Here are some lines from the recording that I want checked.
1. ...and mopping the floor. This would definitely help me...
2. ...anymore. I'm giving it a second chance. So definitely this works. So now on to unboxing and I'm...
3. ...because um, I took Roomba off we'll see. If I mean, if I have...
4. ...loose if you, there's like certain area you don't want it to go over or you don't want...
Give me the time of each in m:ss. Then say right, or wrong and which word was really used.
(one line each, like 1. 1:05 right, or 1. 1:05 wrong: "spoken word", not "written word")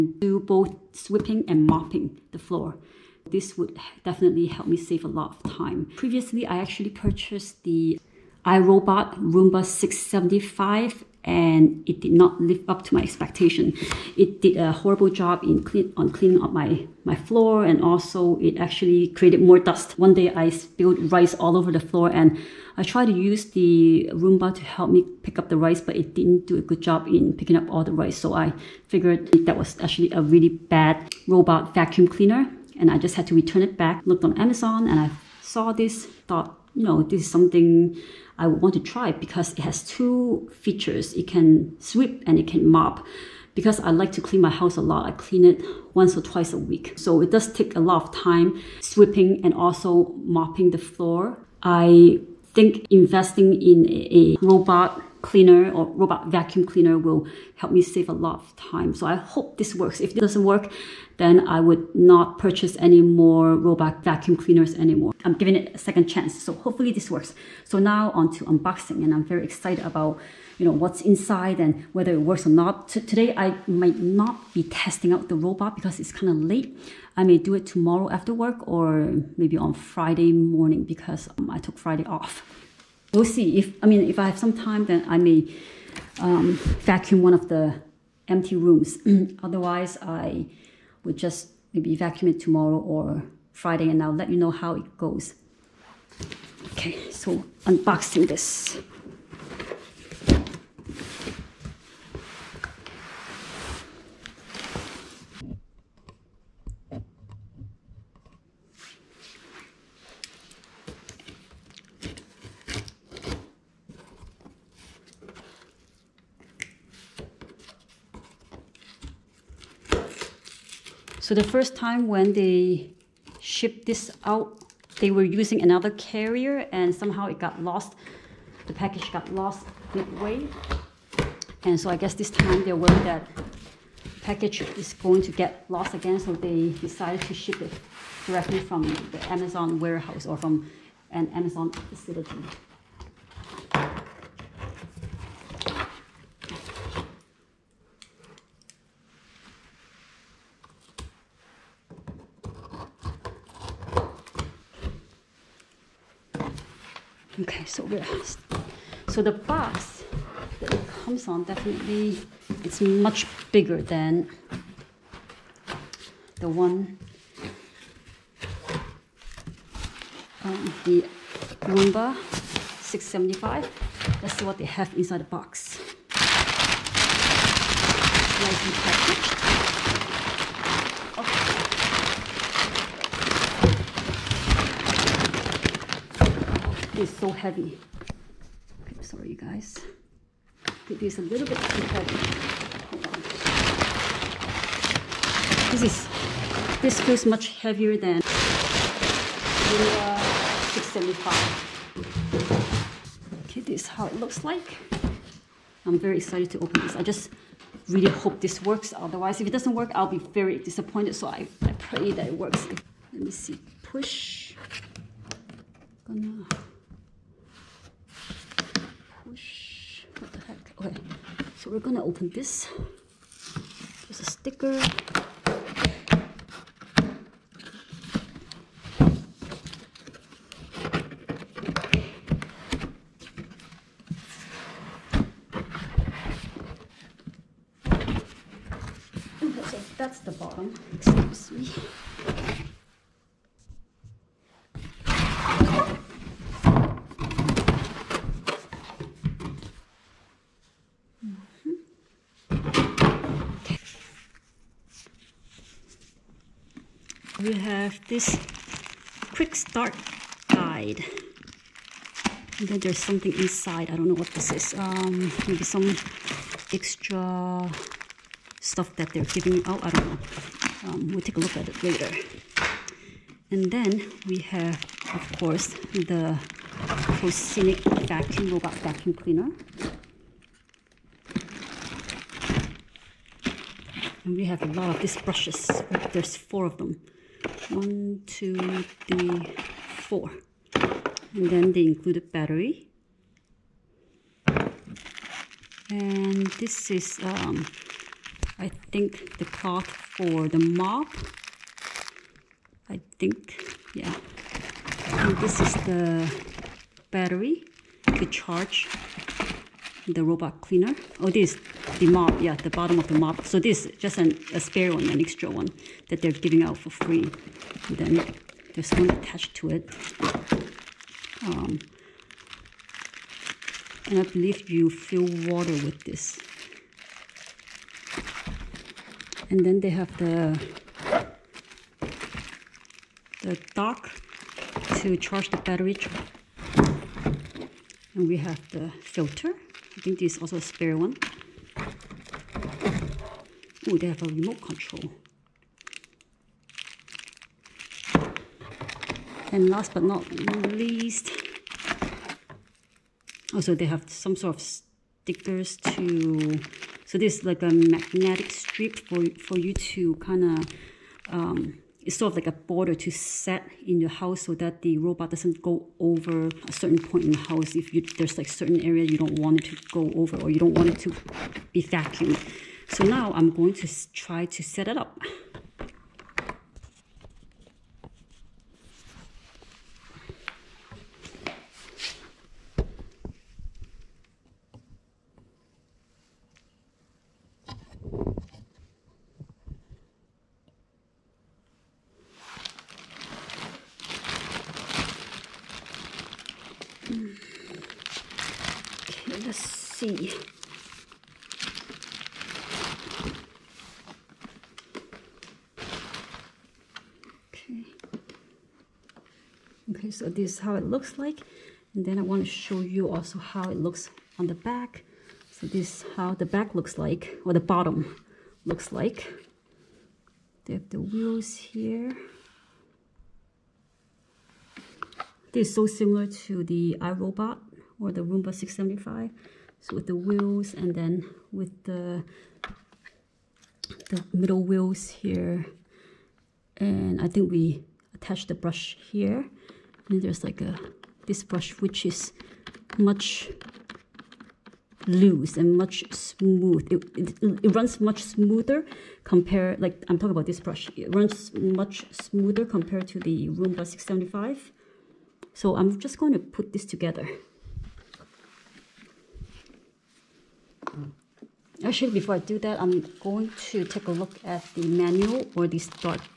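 1. 0:01 right
2. 1:04 wrong: "hopefully", not "definitely"
3. 1:20 wrong: "Friday", not "Roomba"
4. 6:07 wrong: "house", not "loose".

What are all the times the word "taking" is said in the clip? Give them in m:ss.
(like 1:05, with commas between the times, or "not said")
not said.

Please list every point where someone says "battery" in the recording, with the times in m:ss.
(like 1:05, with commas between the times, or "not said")
4:52, 5:07, 5:35.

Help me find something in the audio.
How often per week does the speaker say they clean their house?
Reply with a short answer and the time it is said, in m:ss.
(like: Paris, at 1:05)
once or twice, at 0:45.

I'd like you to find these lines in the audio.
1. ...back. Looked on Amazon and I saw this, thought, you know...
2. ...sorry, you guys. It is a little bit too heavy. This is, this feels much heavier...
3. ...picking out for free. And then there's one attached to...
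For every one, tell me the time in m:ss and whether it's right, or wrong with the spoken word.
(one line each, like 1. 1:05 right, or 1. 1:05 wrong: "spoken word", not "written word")
1. 0:33 right
2. 3:09 right
3. 5:16 wrong: "giving", not "picking".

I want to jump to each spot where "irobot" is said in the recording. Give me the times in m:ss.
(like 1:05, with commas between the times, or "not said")
0:08, 7:07.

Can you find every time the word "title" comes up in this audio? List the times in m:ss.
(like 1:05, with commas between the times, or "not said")
not said.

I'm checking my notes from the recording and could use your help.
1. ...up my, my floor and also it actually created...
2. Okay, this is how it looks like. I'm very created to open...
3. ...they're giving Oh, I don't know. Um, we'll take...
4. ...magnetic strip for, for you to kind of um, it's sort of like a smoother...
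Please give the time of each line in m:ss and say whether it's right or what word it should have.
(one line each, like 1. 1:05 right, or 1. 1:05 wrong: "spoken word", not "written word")
1. 0:16 right
2. 3:23 wrong: "excited", not "created"
3. 4:29 right
4. 5:57 wrong: "border", not "smoother".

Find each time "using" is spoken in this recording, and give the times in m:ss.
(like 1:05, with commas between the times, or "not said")
2:05.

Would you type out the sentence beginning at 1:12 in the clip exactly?
T today I might not be testing out the robot because it's kind of late.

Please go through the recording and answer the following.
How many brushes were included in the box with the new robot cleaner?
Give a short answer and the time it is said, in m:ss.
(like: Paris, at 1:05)
4, at 4:46.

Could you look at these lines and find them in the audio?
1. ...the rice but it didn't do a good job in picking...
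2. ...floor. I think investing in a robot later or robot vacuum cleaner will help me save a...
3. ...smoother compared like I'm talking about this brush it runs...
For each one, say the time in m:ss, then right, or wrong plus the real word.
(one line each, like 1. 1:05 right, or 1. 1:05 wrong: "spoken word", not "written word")
1. 0:25 right
2. 0:50 wrong: "cleaner", not "later"
3. 7:28 right.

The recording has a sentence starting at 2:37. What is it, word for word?
Okay, so we're so the box that it comes on definitely it's much bigger than the one um, the Roomba 675.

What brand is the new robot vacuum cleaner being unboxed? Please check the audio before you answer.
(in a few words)
Proscenic.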